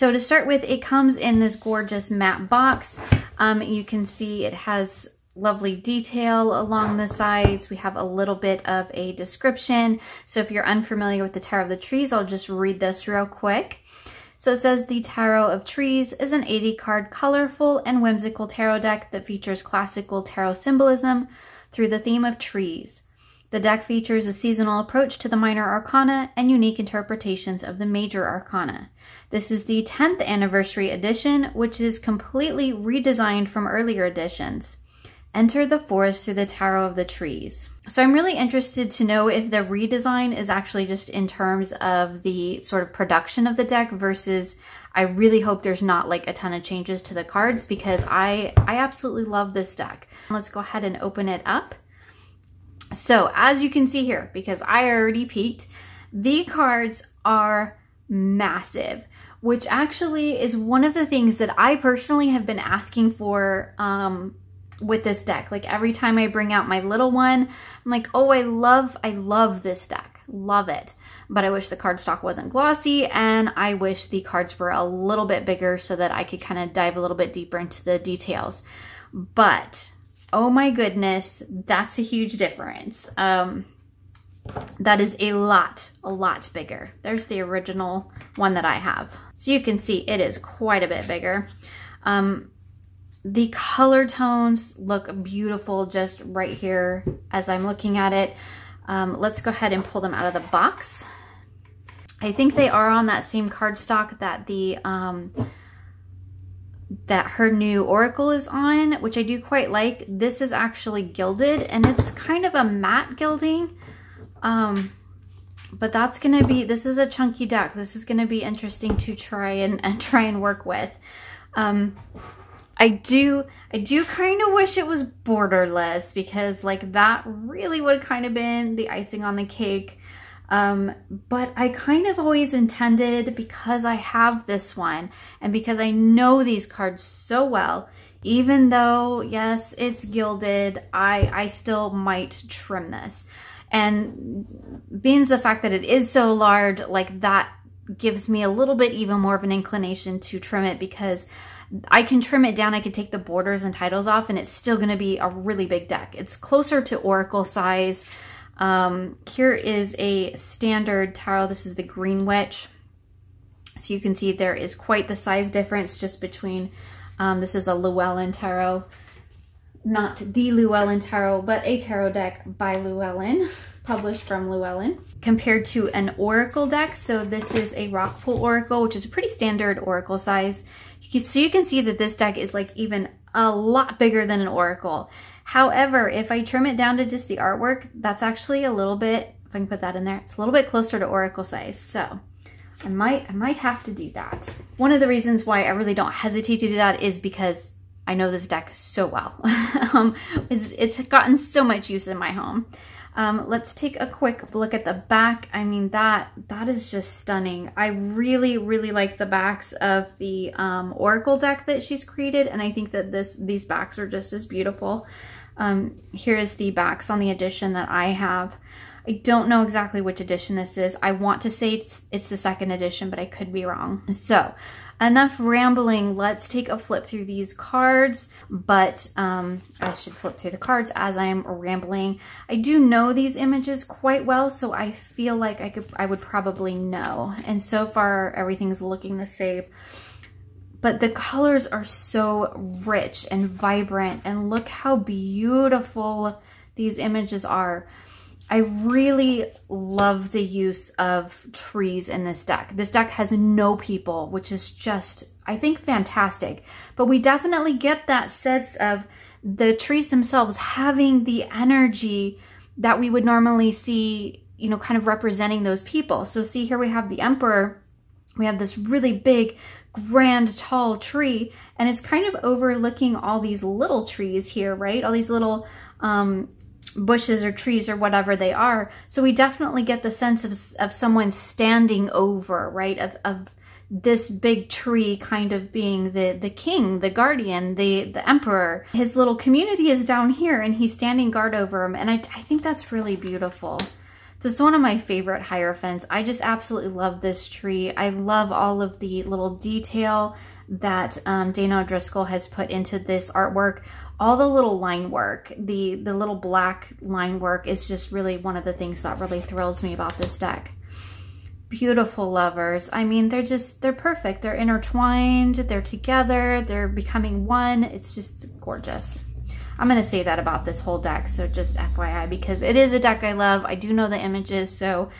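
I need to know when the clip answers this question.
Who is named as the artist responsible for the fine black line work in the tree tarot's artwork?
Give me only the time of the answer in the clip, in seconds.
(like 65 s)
301 s.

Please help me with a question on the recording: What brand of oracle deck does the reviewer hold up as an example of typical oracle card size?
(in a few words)
Rockpool.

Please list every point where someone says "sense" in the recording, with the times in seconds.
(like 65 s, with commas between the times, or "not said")
258 s, 280 s.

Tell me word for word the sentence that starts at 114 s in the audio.
Um, but that's going to be, this is a chunky deck.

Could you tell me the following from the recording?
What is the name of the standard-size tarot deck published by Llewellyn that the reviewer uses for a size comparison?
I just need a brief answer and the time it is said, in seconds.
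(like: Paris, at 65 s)
Green Witch, at 161 s.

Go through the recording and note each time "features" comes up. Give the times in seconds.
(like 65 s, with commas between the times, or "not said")
19 s, 23 s.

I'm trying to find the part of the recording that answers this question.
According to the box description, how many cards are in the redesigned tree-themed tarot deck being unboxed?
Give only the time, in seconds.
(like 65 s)
16 s.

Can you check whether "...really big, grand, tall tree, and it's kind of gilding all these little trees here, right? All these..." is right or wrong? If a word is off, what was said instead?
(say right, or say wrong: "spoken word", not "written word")
wrong: "overlooking", not "gilding".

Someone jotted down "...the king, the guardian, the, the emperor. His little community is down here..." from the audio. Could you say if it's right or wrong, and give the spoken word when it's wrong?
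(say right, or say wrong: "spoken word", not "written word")
right.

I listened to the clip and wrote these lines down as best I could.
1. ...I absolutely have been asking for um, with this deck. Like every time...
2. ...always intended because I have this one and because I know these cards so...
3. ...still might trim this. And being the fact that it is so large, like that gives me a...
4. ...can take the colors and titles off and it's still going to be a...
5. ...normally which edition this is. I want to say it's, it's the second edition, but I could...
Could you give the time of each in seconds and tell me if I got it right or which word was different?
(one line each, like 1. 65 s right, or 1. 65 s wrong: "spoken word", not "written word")
1. 61 s wrong: "personally", not "absolutely"
2. 132 s right
3. 141 s right
4. 152 s wrong: "borders", not "colors"
5. 219 s wrong: "exactly", not "normally".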